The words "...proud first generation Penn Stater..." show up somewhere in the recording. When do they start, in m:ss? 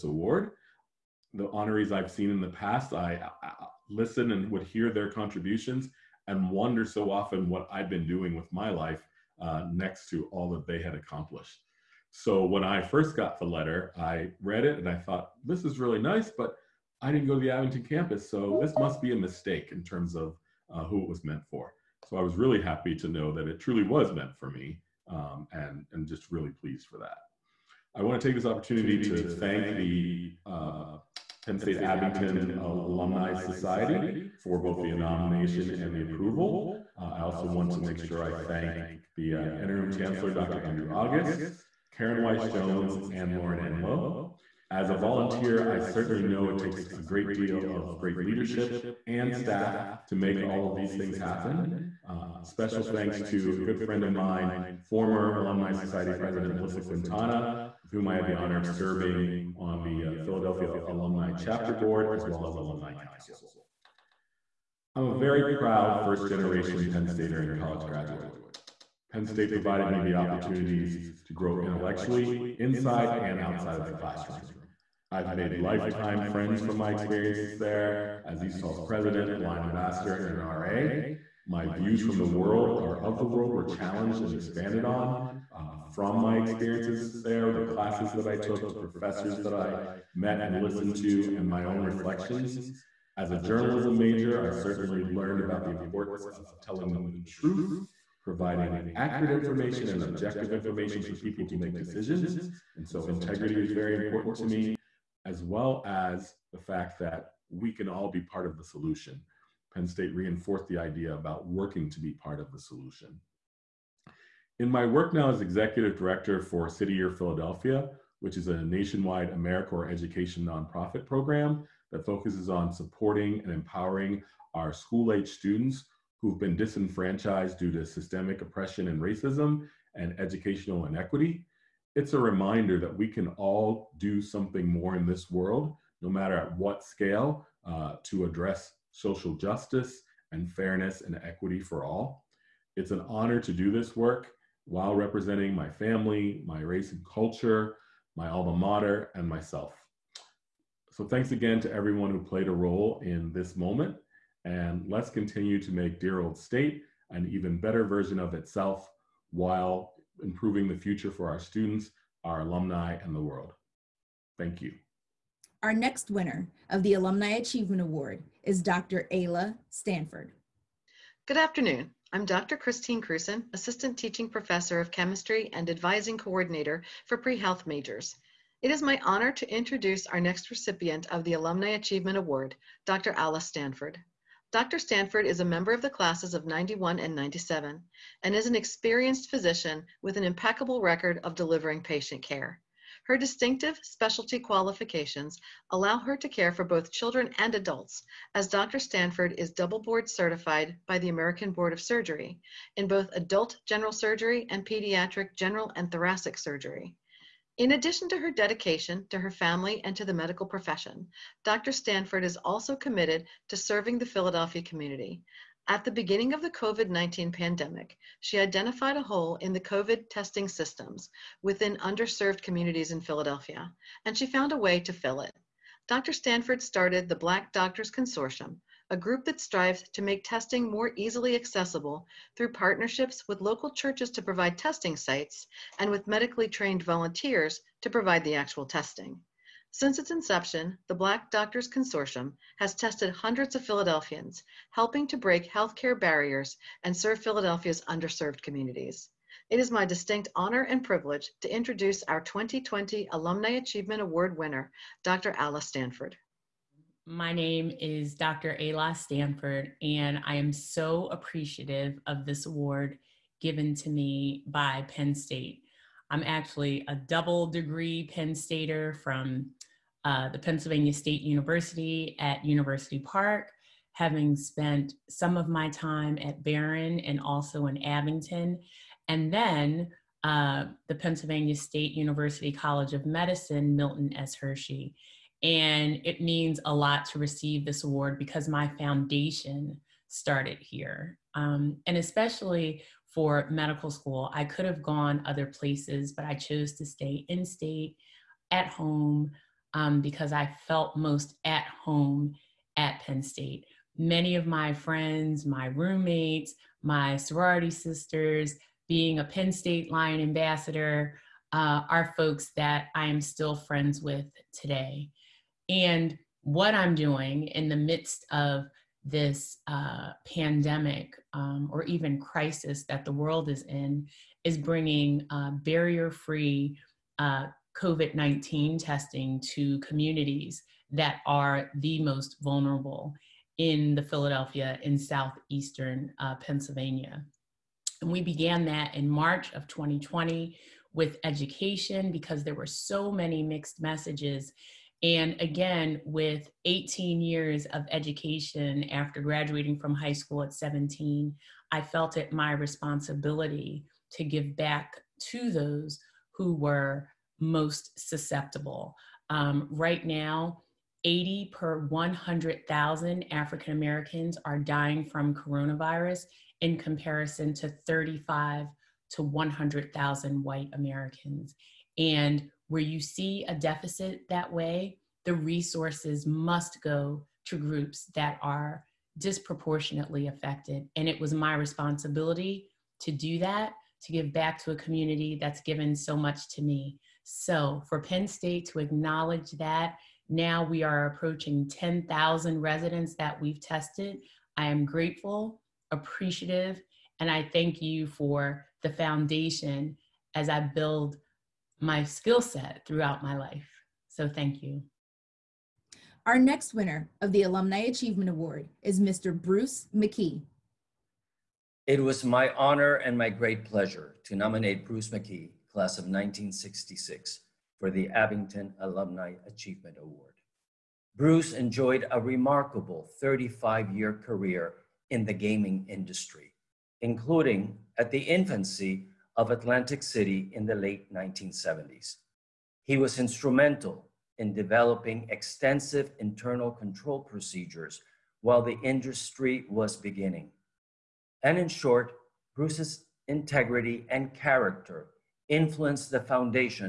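1:05.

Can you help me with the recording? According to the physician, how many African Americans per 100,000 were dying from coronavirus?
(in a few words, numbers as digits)
80.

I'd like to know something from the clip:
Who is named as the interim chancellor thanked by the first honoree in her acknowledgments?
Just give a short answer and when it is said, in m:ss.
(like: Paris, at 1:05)
Dr. Andrew August, at 0:40.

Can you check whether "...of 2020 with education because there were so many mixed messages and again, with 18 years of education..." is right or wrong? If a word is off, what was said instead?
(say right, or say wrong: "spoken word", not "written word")
right.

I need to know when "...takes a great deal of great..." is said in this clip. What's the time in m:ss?
0:46.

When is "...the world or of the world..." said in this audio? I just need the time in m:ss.
1:22.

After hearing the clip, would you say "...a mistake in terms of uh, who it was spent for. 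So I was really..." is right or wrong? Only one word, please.
wrong.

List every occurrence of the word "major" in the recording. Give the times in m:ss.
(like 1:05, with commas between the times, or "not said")
1:33, 2:57.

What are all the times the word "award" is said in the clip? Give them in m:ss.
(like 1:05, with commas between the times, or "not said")
0:00, 2:47, 3:02, 4:14, 4:22, 4:47, 6:48, 6:59.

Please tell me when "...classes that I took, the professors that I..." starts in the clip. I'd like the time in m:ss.
1:27.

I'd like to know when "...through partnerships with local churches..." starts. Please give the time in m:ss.
3:52.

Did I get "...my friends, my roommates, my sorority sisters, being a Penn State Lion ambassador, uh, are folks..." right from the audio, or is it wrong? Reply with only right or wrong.
right.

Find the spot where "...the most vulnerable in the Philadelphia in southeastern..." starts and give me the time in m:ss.
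5:31.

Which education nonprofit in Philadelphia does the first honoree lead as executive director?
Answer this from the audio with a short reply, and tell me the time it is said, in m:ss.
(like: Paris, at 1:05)
City Year Philadelphia, at 1:56.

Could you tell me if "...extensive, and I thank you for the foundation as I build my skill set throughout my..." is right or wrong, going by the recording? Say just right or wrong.
wrong.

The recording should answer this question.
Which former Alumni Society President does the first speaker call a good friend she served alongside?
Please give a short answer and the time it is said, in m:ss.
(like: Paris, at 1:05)
Melissa Quintana, at 0:56.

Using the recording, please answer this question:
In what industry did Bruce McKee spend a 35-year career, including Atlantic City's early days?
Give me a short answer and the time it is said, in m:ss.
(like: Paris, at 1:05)
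Gaming industry, at 7:05.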